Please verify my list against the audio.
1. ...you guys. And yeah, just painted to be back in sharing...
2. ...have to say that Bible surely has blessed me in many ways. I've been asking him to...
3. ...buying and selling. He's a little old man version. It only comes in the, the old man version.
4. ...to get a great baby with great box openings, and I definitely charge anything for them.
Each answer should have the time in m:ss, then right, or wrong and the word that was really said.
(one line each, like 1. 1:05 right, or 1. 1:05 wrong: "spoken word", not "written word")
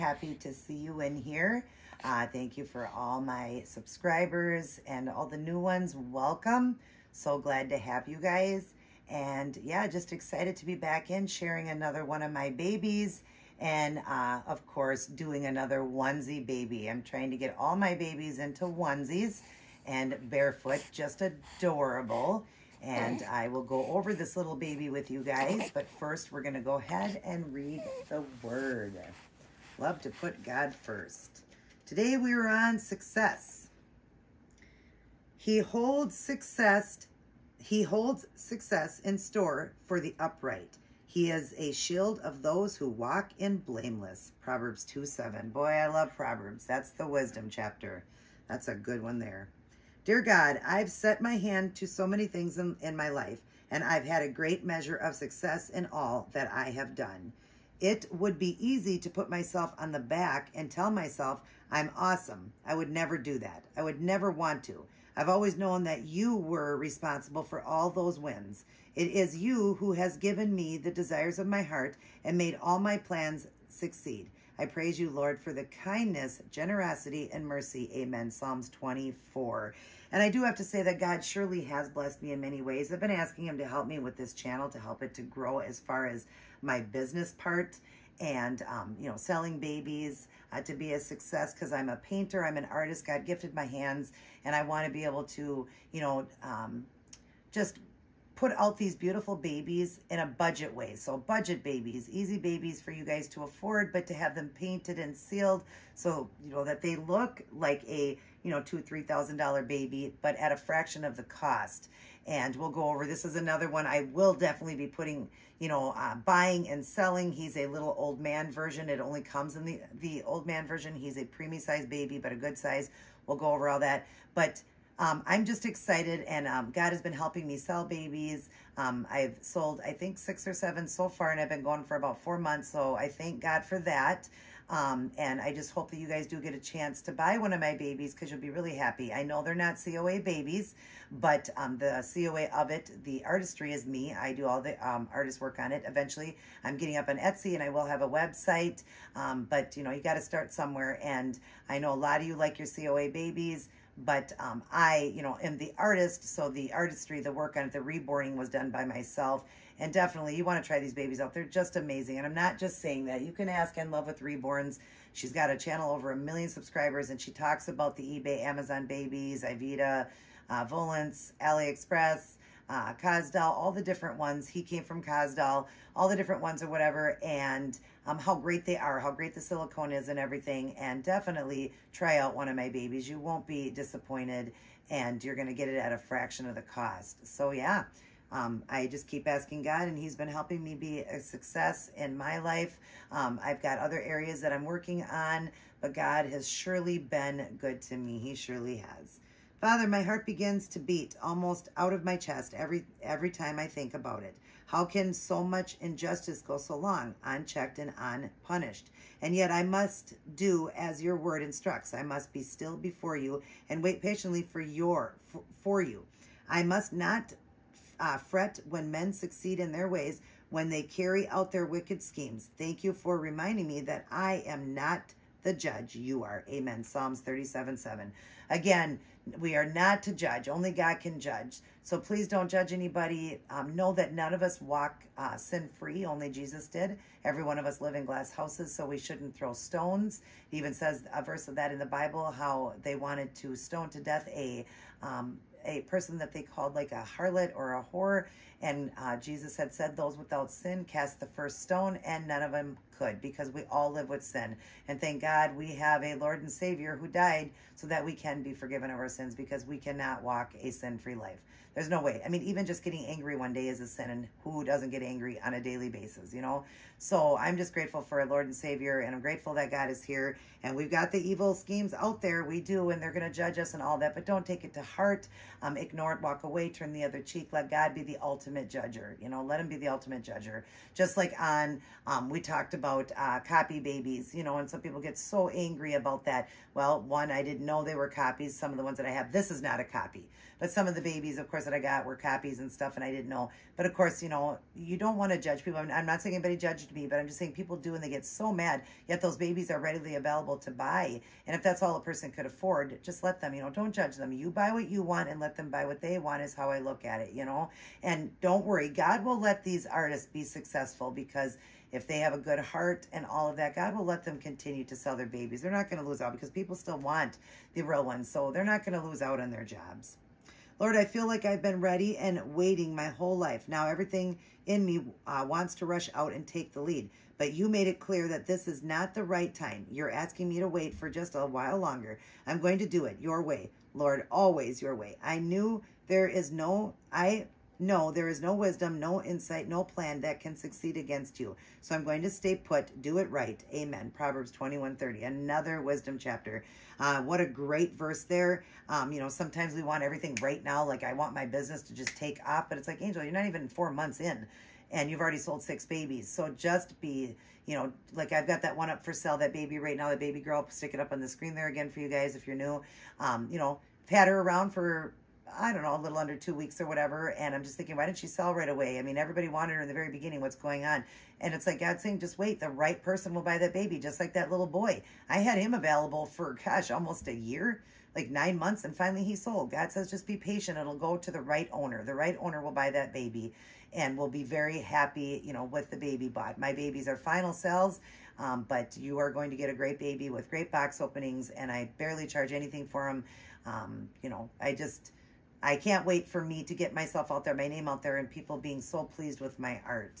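1. 0:08 wrong: "excited", not "painted"
2. 1:20 wrong: "God", not "Bible"
3. 1:56 right
4. 6:29 wrong: "barely", not "definitely".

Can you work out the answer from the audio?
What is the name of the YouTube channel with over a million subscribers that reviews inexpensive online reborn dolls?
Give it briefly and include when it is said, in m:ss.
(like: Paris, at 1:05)
In Love with Reborns, at 2:43.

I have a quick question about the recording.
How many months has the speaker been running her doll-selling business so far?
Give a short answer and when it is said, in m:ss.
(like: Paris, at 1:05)
4, at 2:11.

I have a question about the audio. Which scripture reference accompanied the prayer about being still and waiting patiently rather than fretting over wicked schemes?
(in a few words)
Psalms 37:7.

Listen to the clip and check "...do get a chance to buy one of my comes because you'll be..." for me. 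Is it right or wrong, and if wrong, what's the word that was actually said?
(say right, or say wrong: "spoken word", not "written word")
wrong: "babies", not "comes".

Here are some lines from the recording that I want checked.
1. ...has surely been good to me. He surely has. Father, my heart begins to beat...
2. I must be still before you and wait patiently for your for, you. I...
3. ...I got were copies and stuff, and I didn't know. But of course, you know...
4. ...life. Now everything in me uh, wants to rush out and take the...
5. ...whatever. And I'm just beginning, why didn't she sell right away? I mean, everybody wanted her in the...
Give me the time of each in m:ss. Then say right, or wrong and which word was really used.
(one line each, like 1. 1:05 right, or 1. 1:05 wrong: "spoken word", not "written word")
1. 3:16 right
2. 3:31 right
3. 4:51 right
4. 5:23 right
5. 6:06 wrong: "thinking", not "beginning".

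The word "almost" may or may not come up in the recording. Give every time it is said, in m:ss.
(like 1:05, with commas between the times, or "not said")
3:21, 6:16.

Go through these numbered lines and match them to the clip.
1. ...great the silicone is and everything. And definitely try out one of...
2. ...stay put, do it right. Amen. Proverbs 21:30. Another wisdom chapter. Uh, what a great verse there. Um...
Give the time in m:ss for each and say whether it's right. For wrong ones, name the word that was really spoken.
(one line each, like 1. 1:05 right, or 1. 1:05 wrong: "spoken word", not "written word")
1. 2:59 right
2. 5:42 right.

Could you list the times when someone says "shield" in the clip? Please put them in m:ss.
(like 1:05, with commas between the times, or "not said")
0:41.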